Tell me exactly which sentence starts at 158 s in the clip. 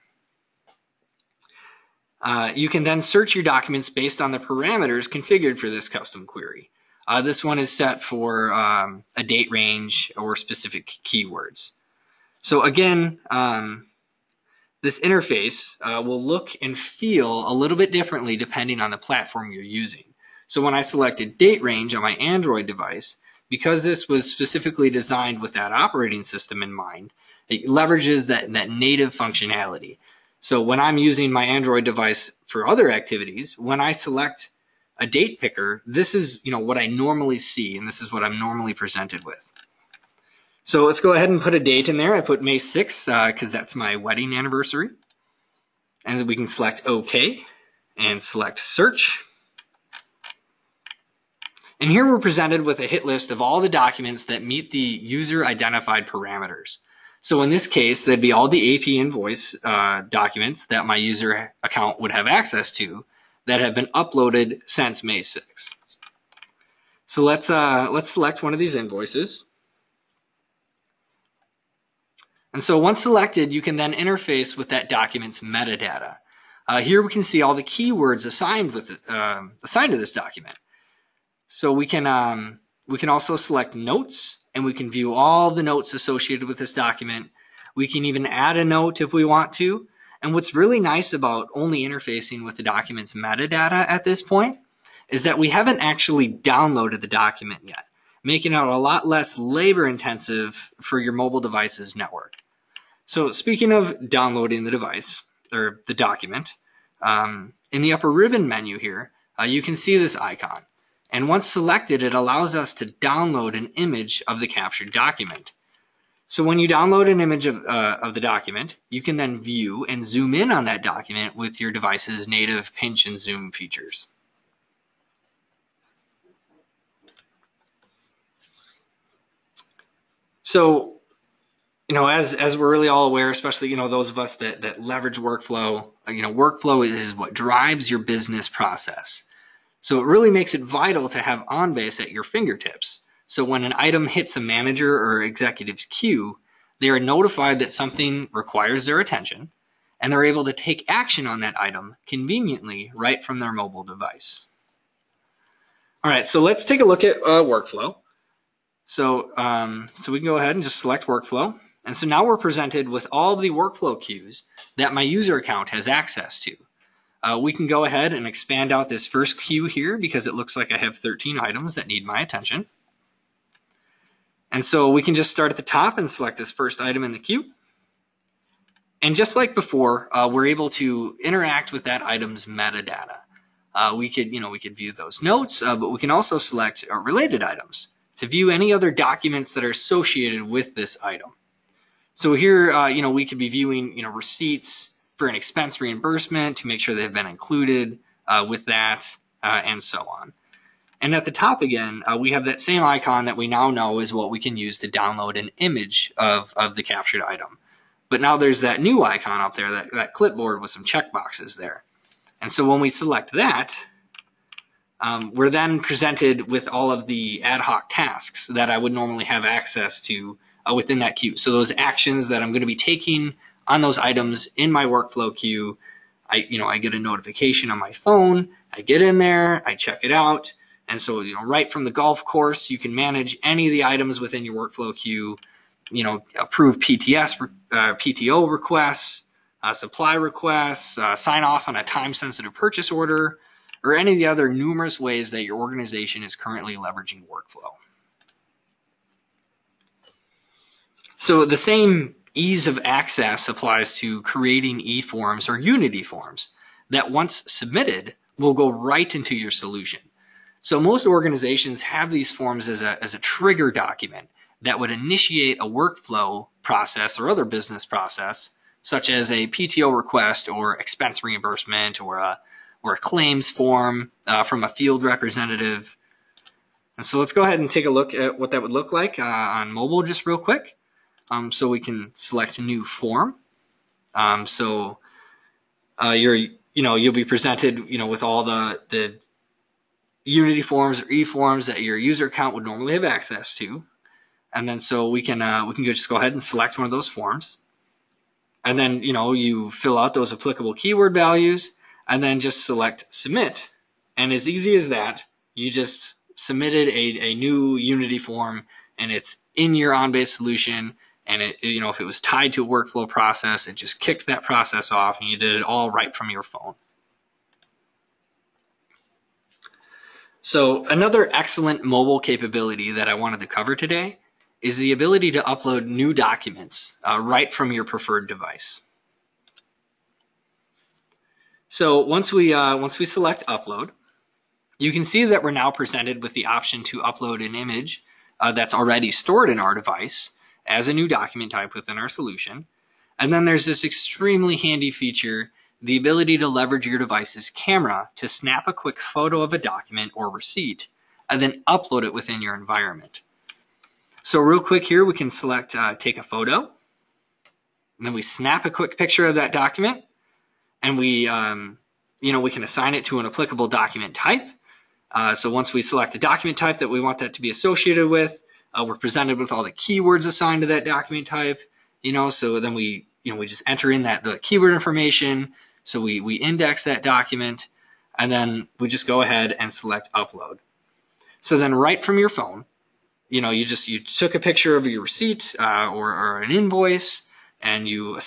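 So, um, so we can go ahead and just select workflow.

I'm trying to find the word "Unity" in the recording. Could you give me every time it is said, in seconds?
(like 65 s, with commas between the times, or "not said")
255 s, 290 s, 307 s.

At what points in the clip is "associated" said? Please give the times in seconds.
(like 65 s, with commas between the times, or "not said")
85 s, 189 s, 367 s.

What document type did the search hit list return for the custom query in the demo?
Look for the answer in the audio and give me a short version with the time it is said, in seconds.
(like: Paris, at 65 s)
AP invoice, at 58 s.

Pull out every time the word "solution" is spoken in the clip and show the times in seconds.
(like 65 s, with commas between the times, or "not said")
259 s, 310 s, 342 s.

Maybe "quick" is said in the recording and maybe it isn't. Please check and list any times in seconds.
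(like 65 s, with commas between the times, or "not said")
280 s, 348 s, 354 s, 358 s.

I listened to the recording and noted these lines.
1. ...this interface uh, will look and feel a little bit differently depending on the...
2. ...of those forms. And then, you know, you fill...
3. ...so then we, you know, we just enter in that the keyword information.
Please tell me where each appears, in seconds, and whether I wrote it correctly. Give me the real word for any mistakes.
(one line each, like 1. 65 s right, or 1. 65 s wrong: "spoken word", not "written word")
1. 14 s right
2. 296 s right
3. 372 s right.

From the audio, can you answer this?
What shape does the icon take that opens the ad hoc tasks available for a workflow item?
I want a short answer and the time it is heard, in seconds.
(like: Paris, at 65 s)
clipboard, at 210 s.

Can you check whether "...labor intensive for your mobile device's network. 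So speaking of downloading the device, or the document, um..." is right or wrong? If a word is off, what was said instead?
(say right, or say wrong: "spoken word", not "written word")
right.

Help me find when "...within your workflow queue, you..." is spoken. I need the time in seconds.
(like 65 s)
234 s.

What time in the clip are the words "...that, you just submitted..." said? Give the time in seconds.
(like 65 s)
304 s.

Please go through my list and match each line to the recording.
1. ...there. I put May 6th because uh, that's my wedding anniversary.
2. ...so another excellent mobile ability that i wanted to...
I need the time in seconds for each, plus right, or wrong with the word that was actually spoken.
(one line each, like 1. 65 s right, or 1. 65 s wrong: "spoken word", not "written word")
1. 41 s right
2. 320 s wrong: "capability", not "ability".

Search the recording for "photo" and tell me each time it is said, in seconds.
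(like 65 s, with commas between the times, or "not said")
348 s, 356 s.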